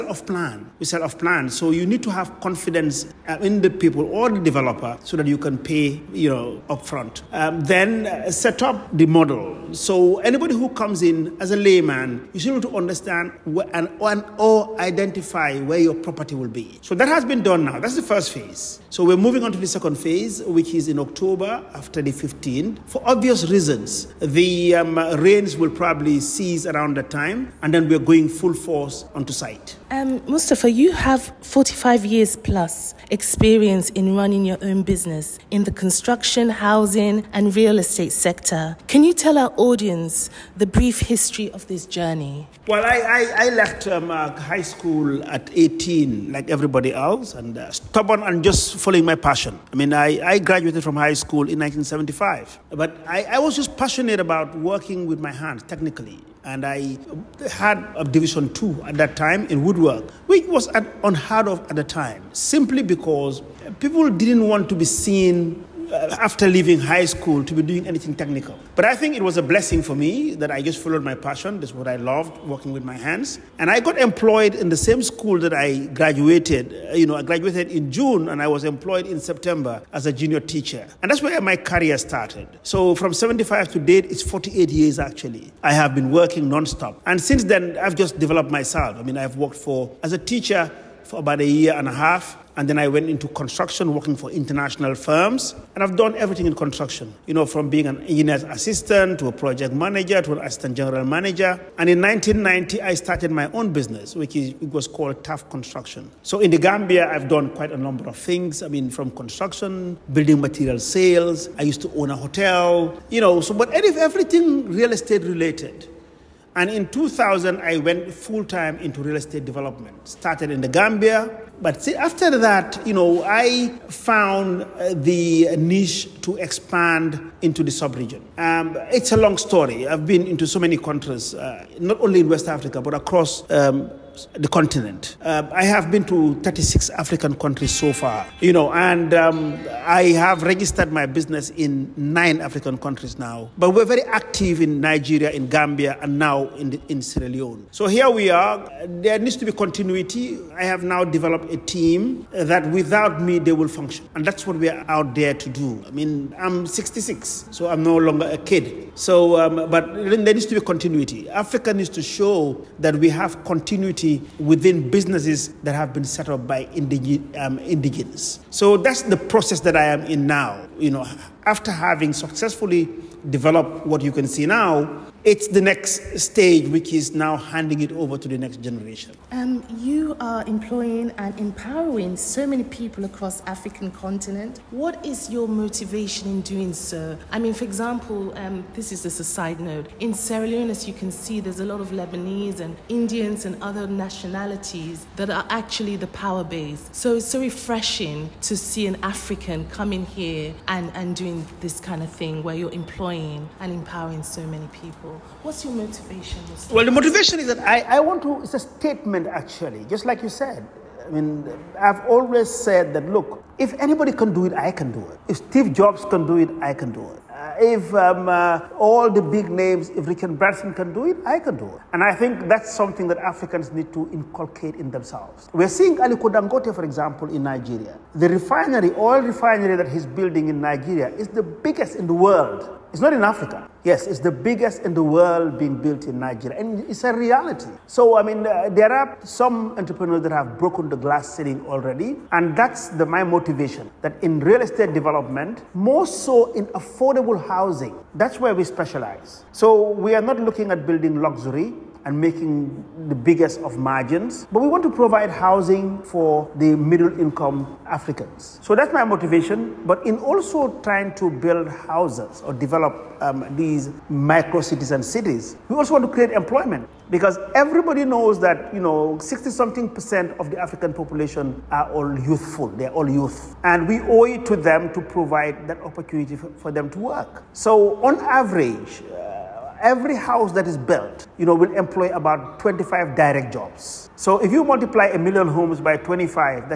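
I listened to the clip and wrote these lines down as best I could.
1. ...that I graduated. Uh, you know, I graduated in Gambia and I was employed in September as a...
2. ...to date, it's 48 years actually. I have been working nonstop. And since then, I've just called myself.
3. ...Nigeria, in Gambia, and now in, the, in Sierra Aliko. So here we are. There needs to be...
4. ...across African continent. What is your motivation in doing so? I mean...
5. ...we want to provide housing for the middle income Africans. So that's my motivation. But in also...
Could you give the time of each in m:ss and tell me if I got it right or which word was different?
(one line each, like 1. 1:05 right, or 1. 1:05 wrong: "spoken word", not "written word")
1. 1:15 wrong: "June", not "Gambia"
2. 1:23 wrong: "developed", not "called"
3. 2:24 wrong: "Leone", not "Aliko"
4. 3:03 right
5. 4:14 right.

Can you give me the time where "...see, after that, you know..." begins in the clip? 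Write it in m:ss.
2:01.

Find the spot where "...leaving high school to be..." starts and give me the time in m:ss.
1:06.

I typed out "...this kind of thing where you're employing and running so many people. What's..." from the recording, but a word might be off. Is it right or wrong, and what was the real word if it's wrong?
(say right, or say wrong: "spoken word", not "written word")
wrong: "empowering", not "running".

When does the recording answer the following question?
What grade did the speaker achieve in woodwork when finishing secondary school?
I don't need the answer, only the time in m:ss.
0:58.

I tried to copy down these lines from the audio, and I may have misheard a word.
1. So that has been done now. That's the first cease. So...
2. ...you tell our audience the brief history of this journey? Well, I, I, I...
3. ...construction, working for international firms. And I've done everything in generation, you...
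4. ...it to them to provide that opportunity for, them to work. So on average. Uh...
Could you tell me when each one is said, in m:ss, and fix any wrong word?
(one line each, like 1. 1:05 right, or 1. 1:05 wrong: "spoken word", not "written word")
1. 0:16 wrong: "phase", not "cease"
2. 0:39 right
3. 1:33 wrong: "construction", not "generation"
4. 4:34 right.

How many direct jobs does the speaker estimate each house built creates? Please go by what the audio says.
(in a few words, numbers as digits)
25.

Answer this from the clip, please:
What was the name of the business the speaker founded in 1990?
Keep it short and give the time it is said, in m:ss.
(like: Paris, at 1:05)
TAF Construction, at 1:45.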